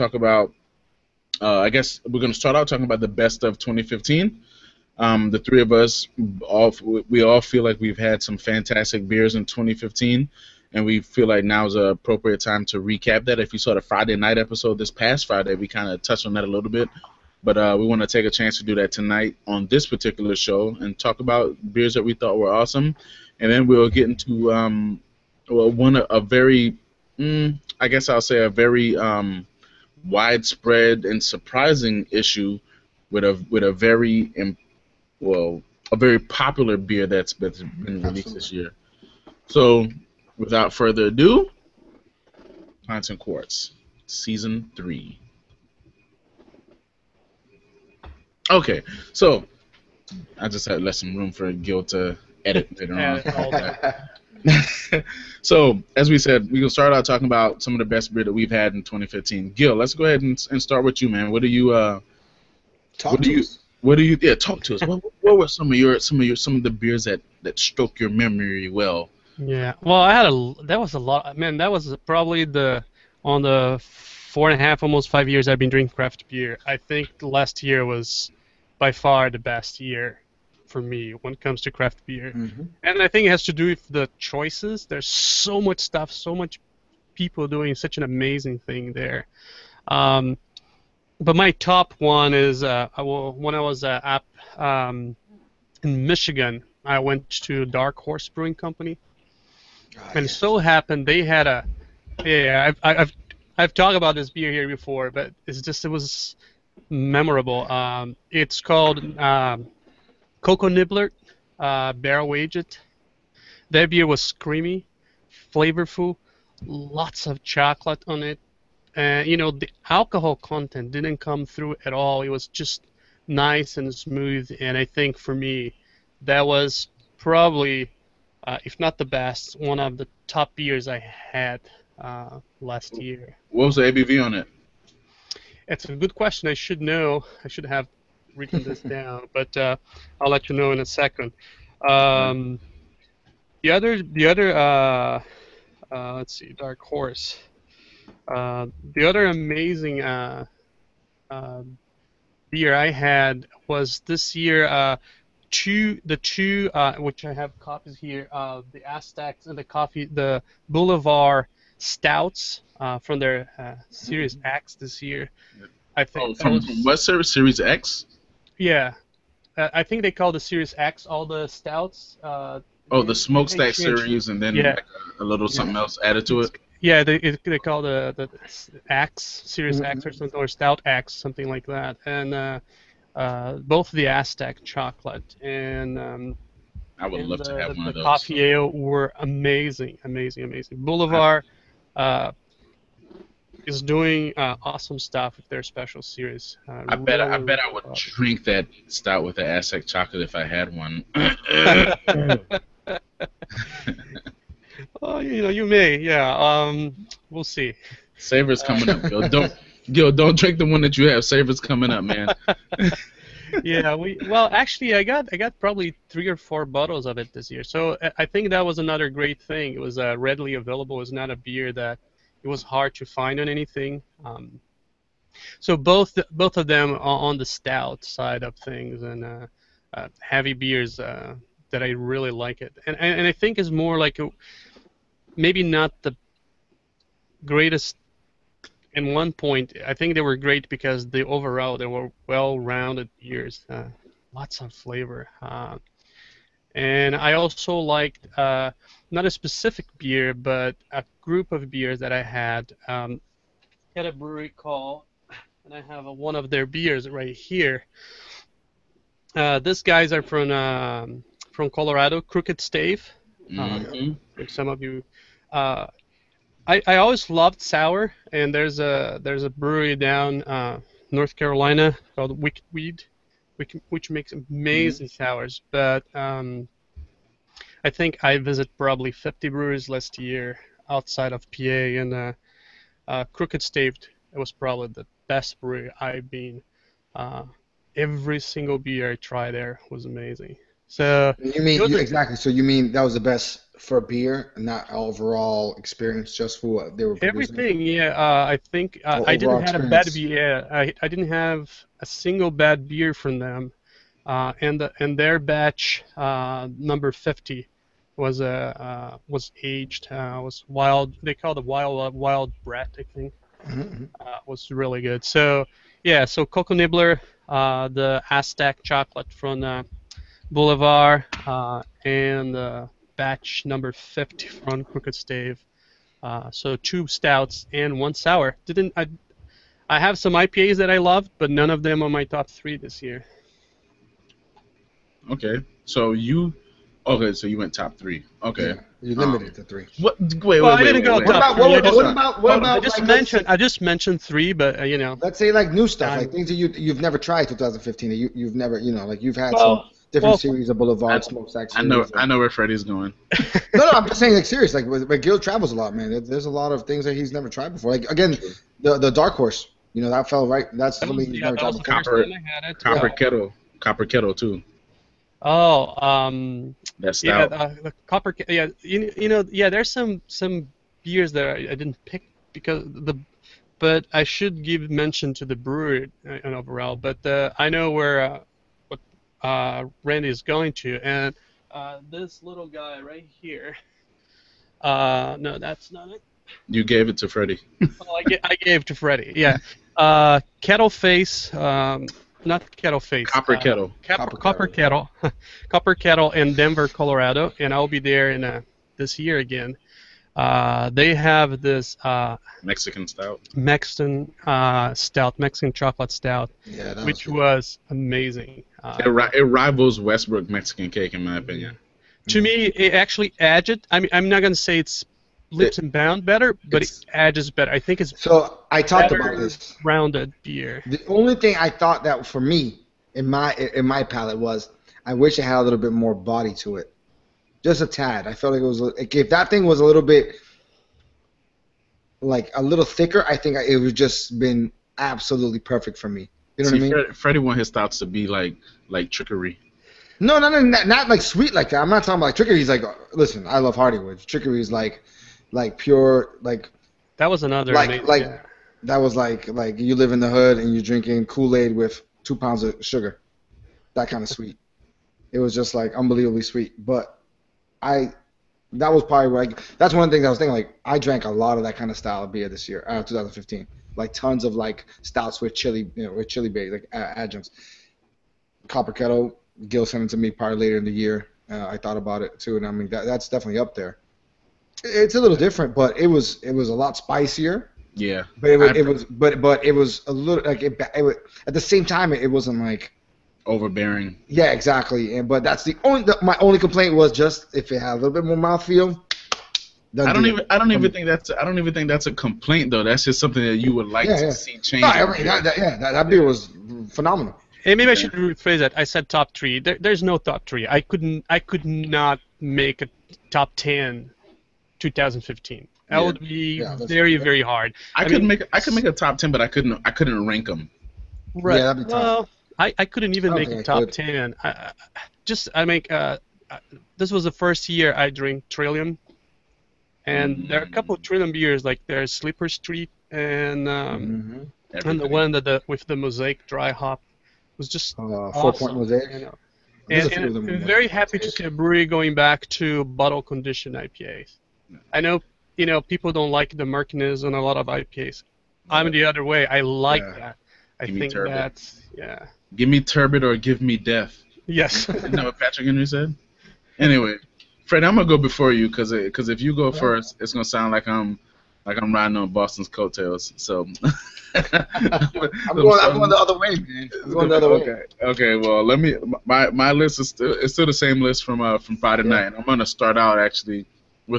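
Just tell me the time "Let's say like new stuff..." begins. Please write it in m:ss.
5:45.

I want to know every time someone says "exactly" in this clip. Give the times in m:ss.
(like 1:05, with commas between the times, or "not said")
4:51, 8:04.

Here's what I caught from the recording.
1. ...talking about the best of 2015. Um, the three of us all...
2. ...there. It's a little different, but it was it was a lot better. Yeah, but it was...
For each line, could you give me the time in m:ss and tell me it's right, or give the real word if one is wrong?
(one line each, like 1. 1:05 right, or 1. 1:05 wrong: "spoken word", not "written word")
1. 0:02 right
2. 7:53 wrong: "spicier", not "better".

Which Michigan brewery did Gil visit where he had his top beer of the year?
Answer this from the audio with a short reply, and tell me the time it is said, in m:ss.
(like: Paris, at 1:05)
Dark Horse Brewing Company, at 1:37.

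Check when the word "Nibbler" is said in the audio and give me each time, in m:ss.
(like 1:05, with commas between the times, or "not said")
1:50, 5:16.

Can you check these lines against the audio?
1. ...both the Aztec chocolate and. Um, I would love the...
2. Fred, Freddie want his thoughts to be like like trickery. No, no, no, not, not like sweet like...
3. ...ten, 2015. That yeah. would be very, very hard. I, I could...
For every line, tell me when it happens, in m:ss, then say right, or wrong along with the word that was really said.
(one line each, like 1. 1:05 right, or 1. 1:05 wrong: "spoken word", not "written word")
1. 3:03 right
2. 7:17 right
3. 8:23 right.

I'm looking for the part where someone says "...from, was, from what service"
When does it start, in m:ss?
2:46.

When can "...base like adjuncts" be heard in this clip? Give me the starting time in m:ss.
7:46.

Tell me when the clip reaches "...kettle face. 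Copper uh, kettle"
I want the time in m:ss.
6:32.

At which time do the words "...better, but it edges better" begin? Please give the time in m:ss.
6:56.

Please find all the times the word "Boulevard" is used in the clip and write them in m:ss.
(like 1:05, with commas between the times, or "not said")
2:40, 3:10, 5:20, 5:50.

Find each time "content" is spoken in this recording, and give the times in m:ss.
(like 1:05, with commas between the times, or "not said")
2:00.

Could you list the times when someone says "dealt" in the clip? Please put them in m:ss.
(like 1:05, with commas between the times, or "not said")
not said.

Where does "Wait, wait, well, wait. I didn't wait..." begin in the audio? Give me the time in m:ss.
5:40.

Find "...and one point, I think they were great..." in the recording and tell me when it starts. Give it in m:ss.
3:58.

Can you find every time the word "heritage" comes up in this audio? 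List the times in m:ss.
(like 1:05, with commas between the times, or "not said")
not said.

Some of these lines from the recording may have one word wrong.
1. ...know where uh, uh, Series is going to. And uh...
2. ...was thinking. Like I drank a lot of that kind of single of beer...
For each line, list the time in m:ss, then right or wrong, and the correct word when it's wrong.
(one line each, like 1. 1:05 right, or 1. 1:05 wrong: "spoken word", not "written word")
1. 6:17 wrong: "Randy", not "Series"
2. 7:40 wrong: "style", not "single".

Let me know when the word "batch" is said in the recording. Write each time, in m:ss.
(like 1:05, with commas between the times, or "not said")
5:05, 5:23.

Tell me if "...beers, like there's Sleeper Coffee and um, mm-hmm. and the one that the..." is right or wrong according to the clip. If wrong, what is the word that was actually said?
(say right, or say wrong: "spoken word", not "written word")
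wrong: "Street", not "Coffee".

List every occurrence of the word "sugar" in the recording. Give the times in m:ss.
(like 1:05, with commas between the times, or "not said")
7:32.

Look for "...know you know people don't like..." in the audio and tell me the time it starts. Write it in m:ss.
8:55.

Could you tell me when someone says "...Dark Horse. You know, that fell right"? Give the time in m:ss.
5:59.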